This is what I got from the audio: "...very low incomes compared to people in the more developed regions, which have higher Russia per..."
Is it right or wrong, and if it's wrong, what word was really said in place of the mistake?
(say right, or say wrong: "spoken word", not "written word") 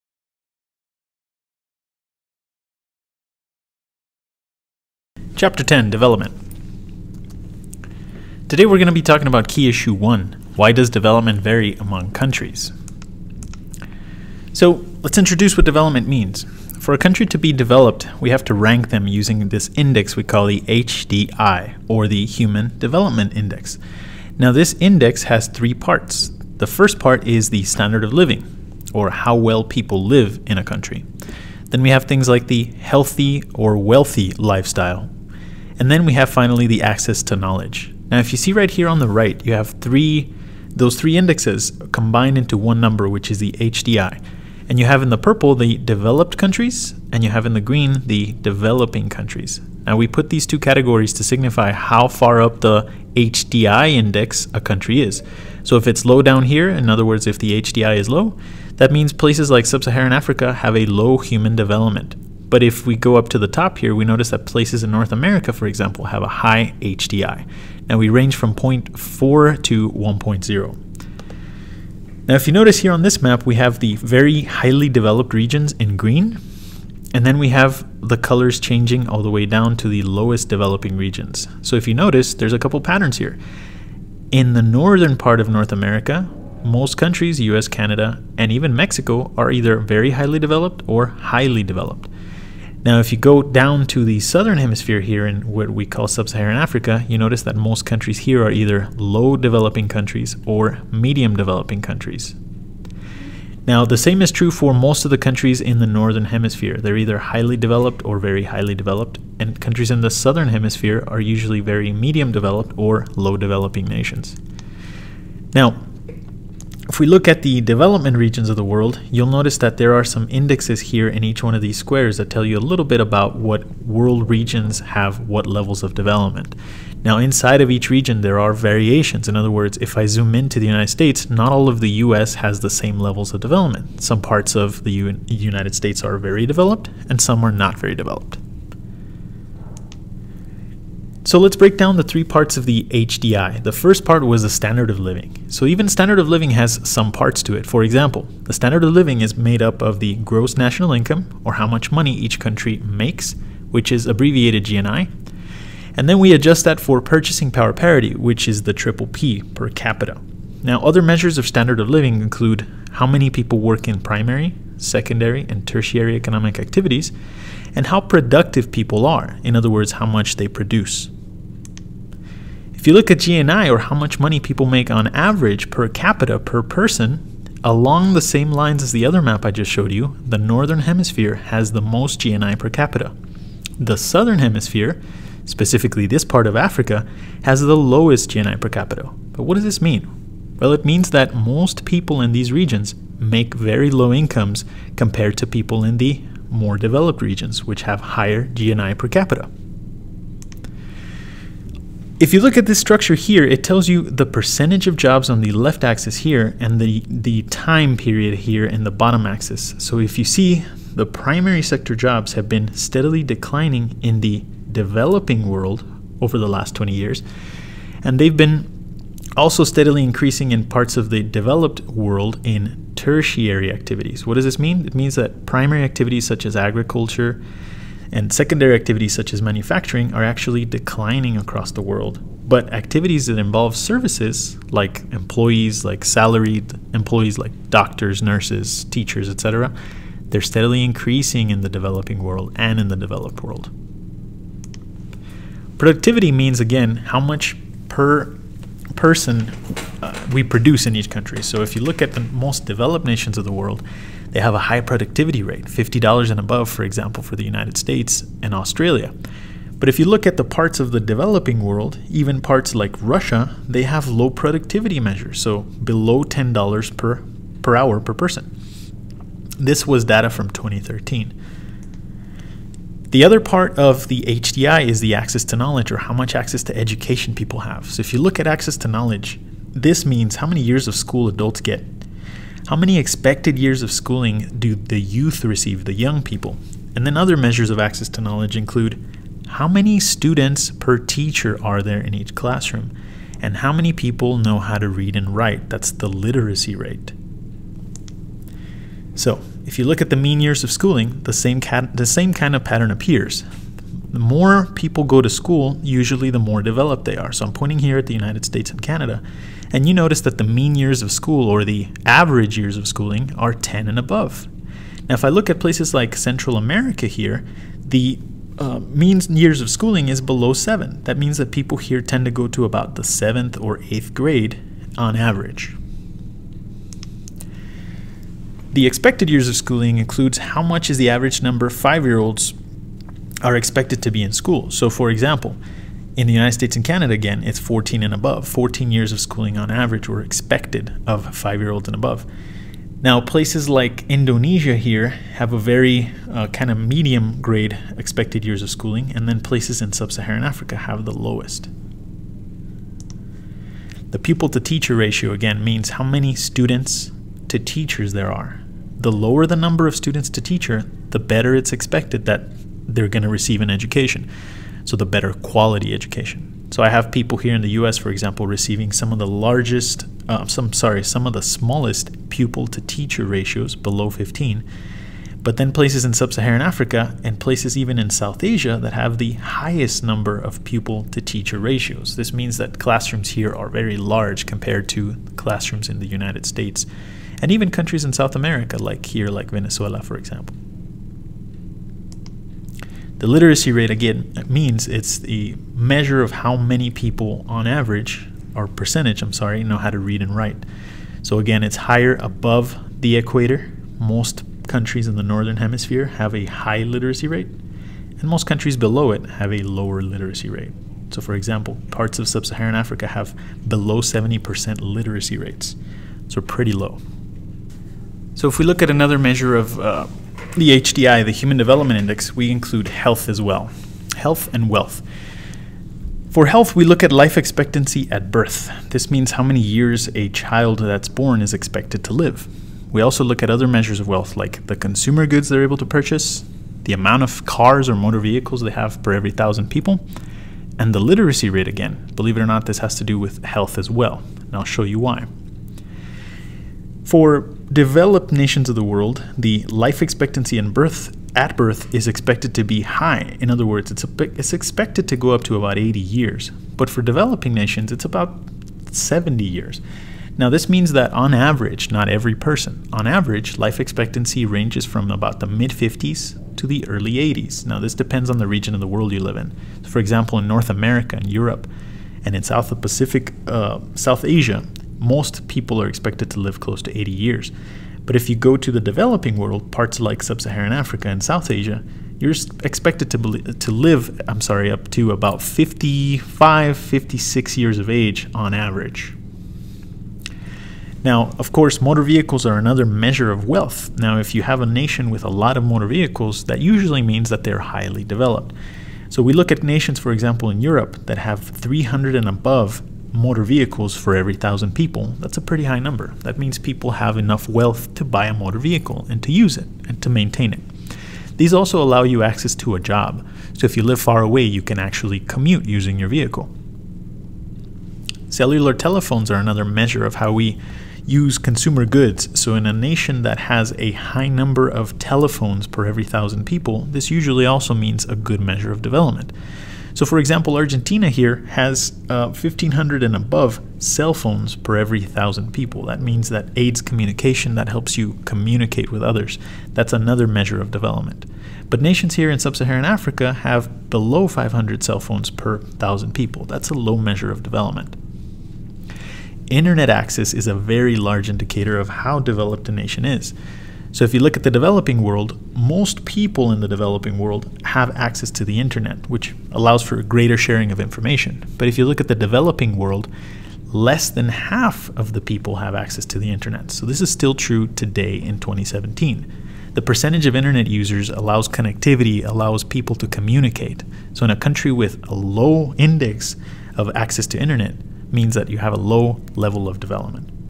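wrong: "GNI", not "Russia".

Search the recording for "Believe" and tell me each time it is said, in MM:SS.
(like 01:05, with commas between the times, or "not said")
07:22.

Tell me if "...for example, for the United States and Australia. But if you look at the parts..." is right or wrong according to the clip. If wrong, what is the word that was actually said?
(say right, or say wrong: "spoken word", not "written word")
right.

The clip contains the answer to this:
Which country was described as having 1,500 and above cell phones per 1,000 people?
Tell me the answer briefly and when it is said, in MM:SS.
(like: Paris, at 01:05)
Argentina, at 08:50.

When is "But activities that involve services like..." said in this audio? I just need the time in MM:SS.
03:52.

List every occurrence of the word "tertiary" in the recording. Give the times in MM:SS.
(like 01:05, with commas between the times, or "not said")
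02:45, 03:42.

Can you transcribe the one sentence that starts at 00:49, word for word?
Now we put these two categories to signify how far up the HDI index a country is.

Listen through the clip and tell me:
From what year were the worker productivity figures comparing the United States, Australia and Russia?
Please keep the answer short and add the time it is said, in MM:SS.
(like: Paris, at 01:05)
2013, at 04:30.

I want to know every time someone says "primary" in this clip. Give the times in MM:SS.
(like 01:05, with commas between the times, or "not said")
02:43, 03:31, 03:45.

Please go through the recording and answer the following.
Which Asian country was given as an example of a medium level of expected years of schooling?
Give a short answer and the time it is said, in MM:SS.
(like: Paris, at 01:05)
Indonesia, at 05:44.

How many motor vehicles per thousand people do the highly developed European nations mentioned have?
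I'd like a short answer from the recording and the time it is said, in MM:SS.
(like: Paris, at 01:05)
300 and above, at 08:21.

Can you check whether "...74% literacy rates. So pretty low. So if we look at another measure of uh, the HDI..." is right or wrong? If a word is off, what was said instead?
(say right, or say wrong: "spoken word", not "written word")
wrong: "70", not "74".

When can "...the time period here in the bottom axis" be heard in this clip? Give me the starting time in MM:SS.
03:27.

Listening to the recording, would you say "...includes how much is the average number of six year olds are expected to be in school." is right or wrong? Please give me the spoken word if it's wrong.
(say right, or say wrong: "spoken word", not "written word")
wrong: "five", not "six".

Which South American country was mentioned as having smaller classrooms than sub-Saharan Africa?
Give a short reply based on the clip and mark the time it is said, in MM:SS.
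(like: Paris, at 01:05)
Venezuela, at 06:29.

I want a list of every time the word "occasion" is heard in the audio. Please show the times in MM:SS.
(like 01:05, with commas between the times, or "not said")
not said.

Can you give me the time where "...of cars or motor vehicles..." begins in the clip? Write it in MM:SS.
07:17.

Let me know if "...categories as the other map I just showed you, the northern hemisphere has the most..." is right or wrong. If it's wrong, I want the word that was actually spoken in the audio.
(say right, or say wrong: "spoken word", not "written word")
wrong: "lines", not "categories".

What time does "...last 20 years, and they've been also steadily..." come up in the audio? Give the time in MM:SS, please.
03:36.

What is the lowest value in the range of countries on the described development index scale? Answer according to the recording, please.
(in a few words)
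0.4.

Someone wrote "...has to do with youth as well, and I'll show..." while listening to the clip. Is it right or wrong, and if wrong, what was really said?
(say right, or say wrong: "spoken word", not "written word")
wrong: "health", not "youth".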